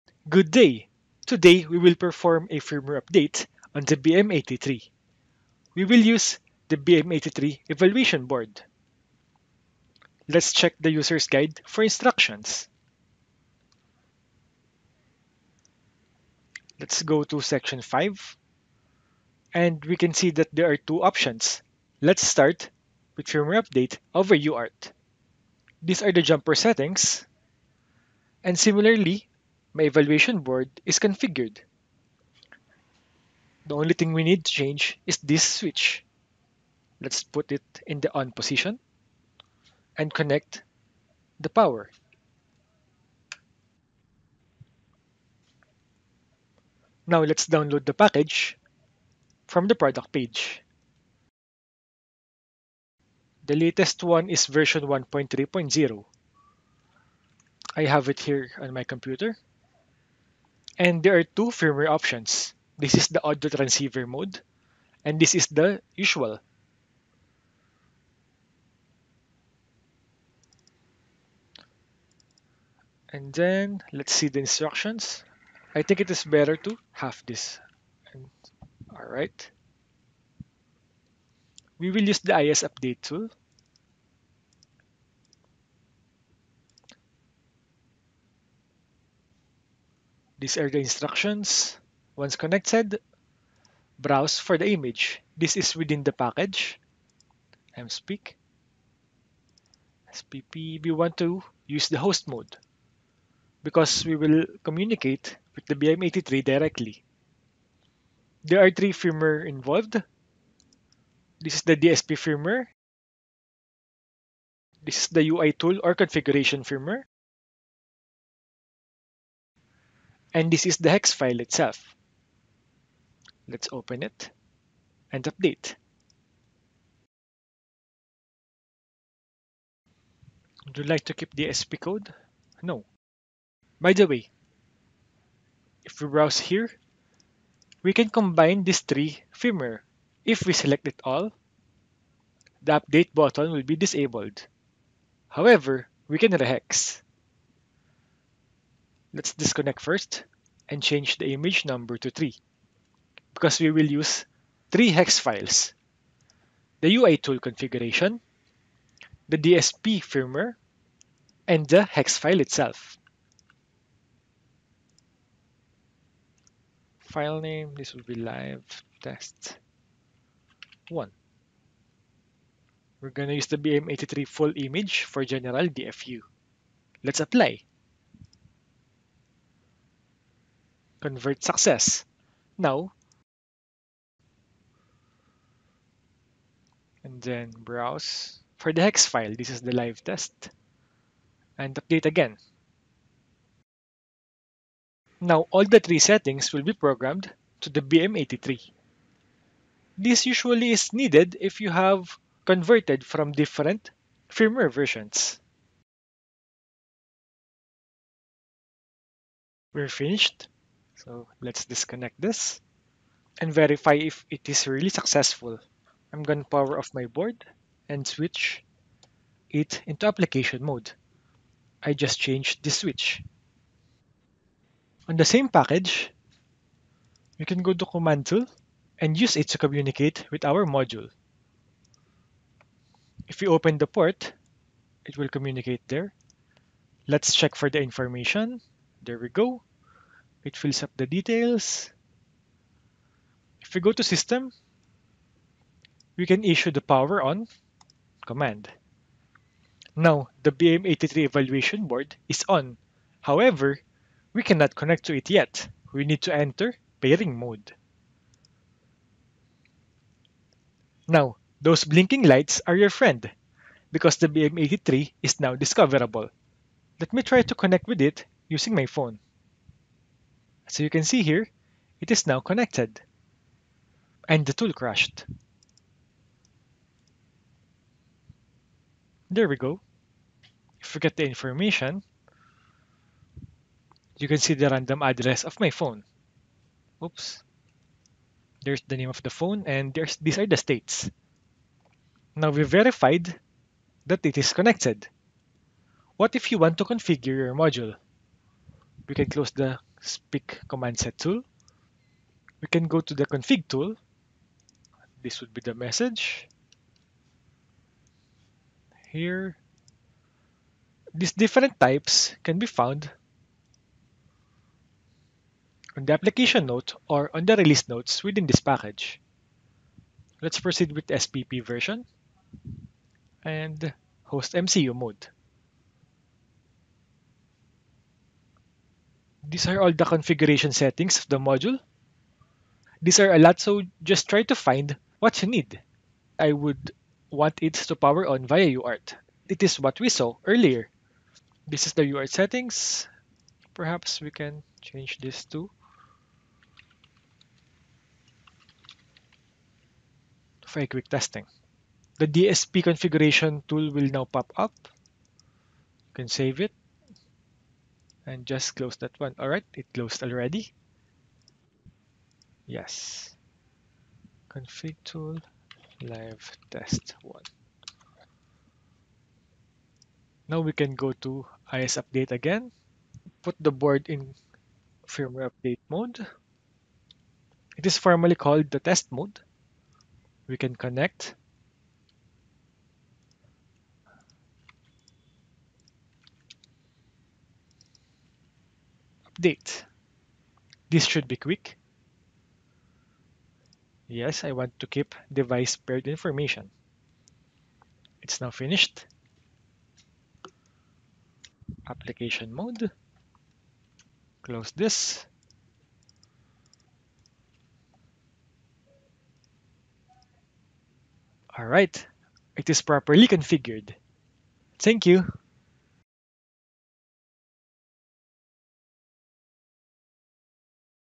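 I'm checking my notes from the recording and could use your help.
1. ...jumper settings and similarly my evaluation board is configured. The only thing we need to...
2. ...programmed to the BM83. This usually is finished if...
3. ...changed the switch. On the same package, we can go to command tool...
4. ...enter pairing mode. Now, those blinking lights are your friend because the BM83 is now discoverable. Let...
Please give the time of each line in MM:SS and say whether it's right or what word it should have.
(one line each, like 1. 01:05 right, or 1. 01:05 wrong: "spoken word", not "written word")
1. 00:26 right
2. 03:16 wrong: "needed", not "finished"
3. 03:42 right
4. 04:16 right.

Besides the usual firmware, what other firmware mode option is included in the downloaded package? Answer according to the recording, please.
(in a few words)
audio transceiver mode.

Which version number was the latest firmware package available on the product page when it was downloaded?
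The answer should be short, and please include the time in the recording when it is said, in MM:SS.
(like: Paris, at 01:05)
1.3.0, at 00:54.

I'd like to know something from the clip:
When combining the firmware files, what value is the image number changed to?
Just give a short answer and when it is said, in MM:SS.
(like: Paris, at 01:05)
3, at 02:32.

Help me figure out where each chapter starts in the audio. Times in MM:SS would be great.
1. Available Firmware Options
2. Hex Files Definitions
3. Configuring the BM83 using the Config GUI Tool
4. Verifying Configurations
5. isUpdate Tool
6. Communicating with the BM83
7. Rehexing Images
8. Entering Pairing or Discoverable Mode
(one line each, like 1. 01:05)
1. 01:00
2. 01:48
3. 04:55
4. 06:40
5. 01:20
6. 03:45
7. 02:13
8. 04:03.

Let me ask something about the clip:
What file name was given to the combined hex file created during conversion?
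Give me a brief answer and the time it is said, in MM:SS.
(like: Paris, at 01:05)
live test 1, at 02:48.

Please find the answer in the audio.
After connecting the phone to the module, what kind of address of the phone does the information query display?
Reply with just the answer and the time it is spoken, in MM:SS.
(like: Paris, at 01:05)
random address, at 04:44.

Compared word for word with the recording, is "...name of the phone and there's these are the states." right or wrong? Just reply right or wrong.
right.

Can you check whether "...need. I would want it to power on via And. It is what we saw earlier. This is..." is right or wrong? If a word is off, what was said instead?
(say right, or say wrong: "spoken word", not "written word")
wrong: "UART", not "And".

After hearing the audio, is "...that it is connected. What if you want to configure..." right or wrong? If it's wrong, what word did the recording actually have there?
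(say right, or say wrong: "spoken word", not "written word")
right.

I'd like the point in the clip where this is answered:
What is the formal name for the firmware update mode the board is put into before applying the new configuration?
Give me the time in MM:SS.
06:18.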